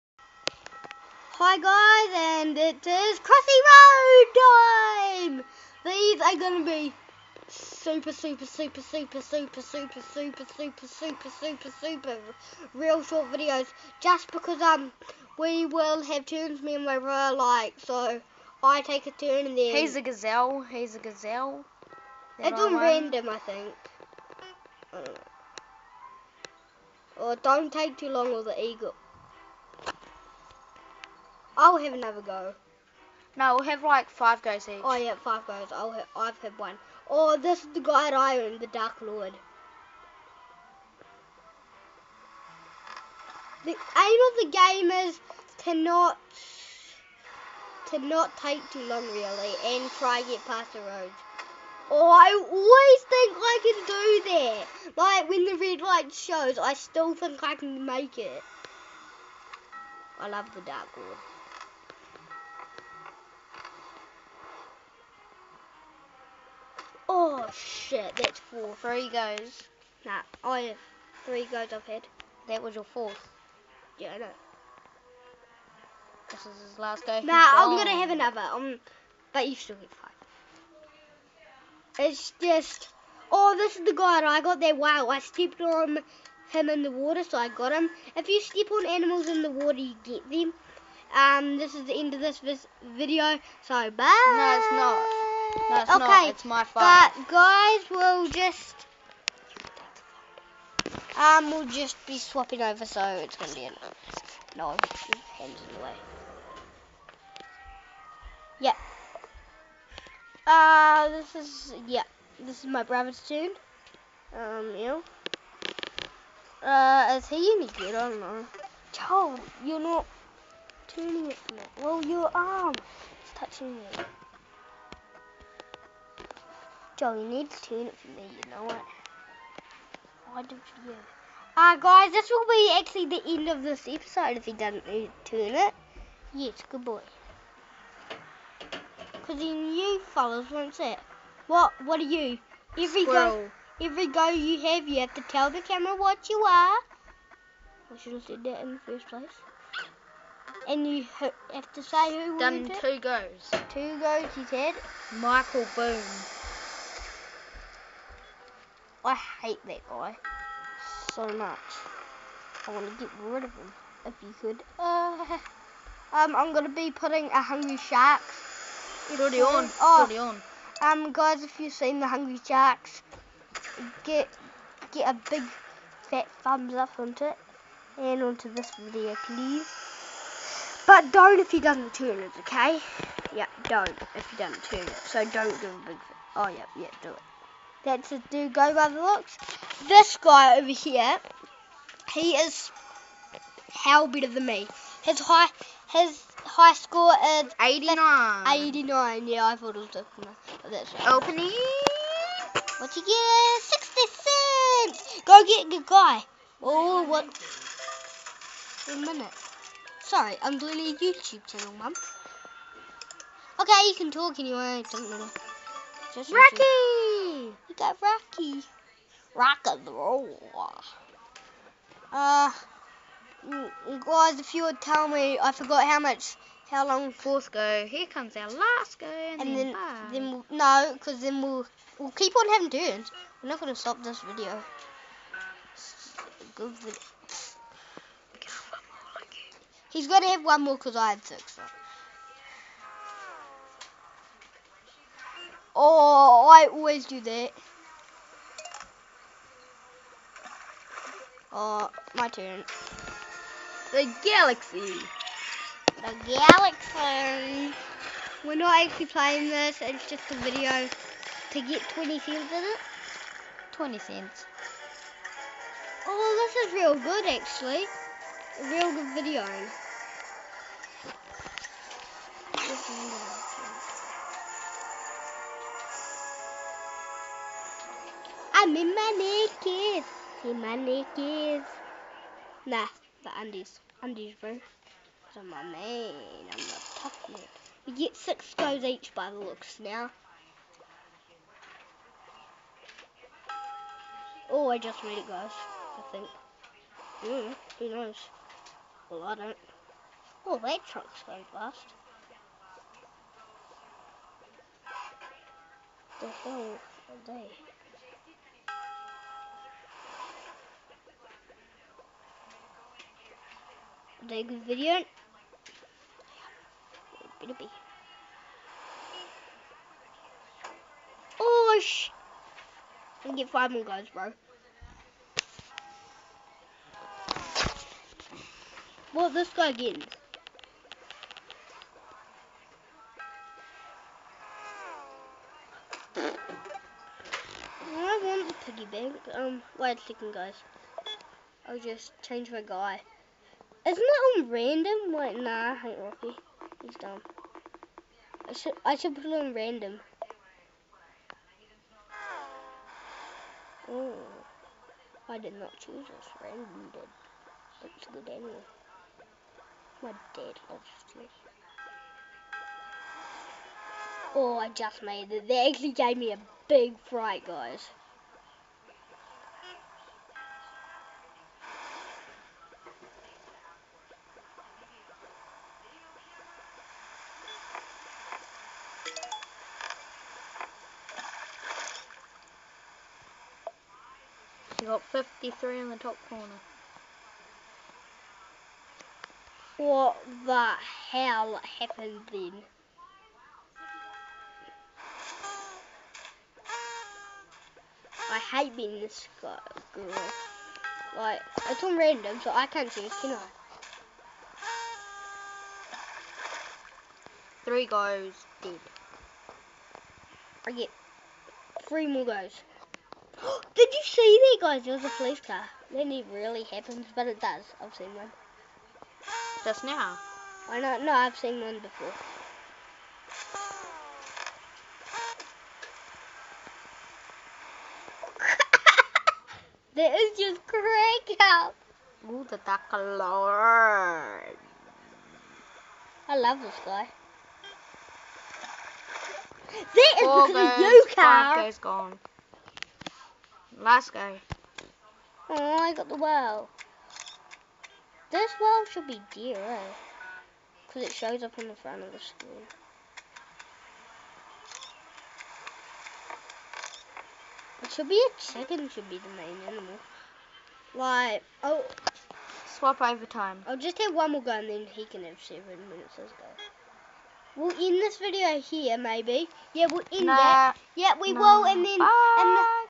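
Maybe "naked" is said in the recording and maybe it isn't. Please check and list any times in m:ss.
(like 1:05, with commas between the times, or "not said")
4:39.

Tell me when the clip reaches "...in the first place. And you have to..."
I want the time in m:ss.
2:28.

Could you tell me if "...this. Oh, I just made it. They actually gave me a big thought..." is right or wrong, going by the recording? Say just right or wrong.
wrong.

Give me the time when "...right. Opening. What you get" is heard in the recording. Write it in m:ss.
3:20.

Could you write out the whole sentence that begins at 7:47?
We'll end this video here, maybe.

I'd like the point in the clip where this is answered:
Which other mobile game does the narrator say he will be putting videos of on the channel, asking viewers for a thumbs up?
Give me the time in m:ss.
2:47.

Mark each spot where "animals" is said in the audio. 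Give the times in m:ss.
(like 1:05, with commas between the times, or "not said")
1:28, 7:39.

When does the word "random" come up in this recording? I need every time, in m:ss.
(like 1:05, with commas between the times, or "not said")
0:22, 5:44, 5:49, 5:56, 6:41.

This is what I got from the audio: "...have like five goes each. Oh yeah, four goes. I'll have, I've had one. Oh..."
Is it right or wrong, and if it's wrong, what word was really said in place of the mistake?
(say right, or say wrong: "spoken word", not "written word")
wrong: "five", not "four".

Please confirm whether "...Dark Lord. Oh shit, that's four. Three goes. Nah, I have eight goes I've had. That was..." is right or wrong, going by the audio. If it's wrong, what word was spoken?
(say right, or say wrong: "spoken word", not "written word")
wrong: "three", not "eight".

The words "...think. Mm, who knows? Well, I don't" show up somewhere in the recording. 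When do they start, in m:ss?
4:56.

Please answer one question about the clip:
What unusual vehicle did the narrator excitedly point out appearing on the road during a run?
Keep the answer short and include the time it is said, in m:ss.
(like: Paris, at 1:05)
police car, at 6:55.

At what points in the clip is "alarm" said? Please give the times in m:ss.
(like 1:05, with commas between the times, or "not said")
7:12.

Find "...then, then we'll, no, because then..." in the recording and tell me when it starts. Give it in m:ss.
3:49.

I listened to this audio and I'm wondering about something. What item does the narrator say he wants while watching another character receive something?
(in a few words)
the piggy bank.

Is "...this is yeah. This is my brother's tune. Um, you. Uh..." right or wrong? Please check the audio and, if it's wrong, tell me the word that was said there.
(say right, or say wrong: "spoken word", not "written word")
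right.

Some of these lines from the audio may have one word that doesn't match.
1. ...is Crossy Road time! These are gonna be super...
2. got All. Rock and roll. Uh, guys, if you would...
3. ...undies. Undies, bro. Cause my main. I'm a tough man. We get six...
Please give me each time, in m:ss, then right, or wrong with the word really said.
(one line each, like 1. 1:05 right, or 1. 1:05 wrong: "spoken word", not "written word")
1. 0:02 right
2. 3:37 wrong: "Rocky", not "All"
3. 4:43 right.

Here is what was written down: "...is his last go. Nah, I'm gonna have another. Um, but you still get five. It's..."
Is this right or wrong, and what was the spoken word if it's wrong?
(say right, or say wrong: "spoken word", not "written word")
right.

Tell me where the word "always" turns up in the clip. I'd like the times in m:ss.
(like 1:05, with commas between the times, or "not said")
0:52, 4:06.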